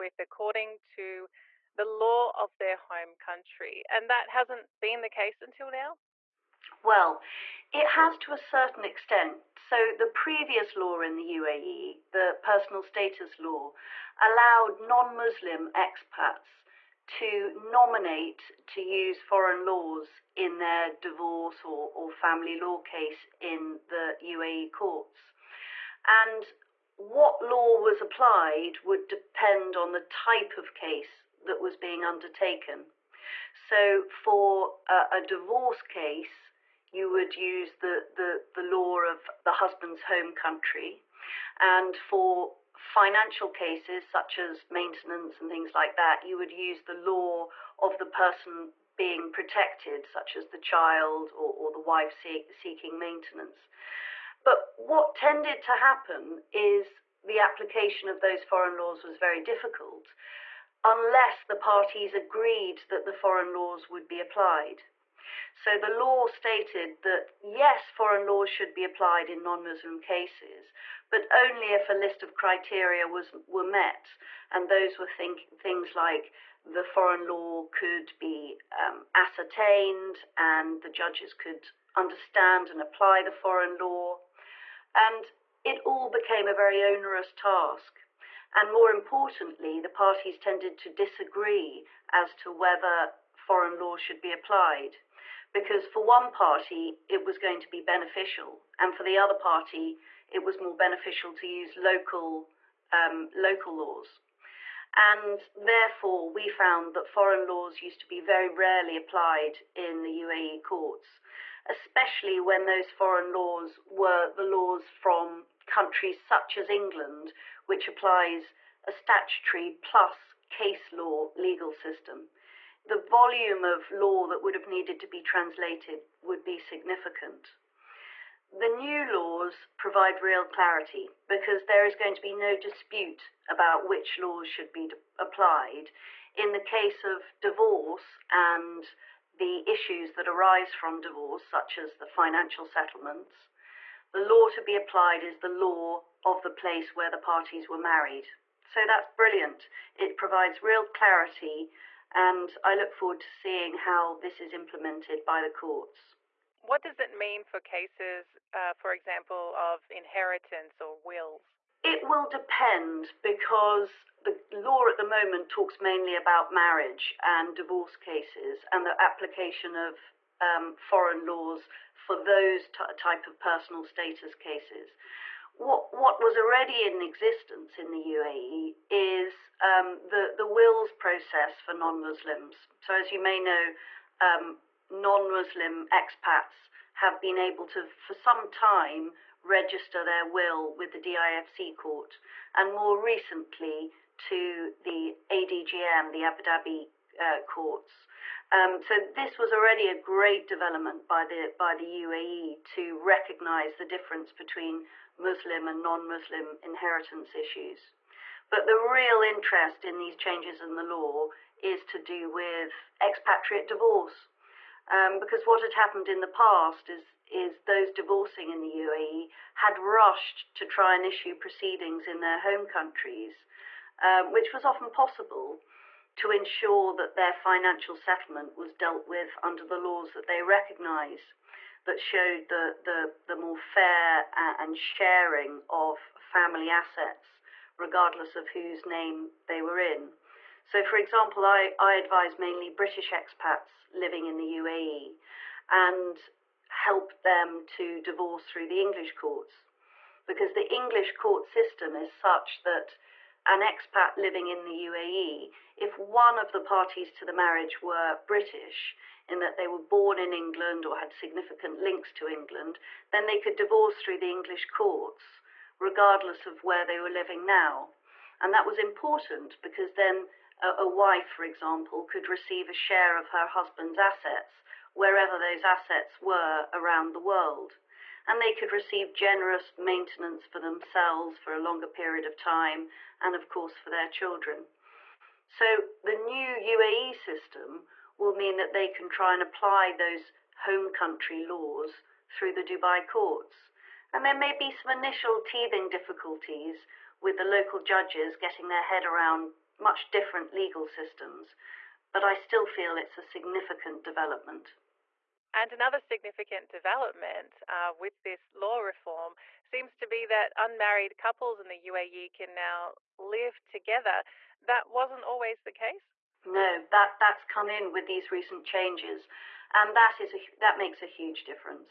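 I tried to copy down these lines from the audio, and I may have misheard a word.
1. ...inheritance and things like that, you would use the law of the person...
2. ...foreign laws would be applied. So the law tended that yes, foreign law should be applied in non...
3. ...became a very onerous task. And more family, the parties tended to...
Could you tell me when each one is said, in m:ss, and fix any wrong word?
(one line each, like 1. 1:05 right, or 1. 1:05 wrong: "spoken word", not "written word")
1. 0:44 wrong: "maintenance", not "inheritance"
2. 1:03 wrong: "stated", not "tended"
3. 1:26 wrong: "importantly", not "family".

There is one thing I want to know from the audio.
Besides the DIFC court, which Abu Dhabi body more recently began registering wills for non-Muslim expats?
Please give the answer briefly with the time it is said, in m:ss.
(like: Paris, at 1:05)
ADGM, at 3:15.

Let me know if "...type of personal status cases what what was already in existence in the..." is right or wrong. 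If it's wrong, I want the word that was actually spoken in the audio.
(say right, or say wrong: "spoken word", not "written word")
right.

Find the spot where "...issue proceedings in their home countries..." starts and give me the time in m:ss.
3:41.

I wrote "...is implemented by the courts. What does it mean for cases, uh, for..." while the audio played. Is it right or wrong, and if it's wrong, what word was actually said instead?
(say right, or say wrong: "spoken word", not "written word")
right.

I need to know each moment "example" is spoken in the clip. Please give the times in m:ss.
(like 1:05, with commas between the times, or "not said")
2:38, 4:00, 4:31.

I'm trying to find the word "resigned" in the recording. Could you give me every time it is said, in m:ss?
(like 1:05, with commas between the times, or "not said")
not said.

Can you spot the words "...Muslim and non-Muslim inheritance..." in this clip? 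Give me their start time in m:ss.
3:25.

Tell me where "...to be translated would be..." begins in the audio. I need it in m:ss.
2:04.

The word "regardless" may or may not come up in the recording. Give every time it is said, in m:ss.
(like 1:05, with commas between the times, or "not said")
3:57, 4:25.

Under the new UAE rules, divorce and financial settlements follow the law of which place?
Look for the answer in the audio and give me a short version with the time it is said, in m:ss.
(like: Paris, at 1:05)
Where the parties were married, at 2:26.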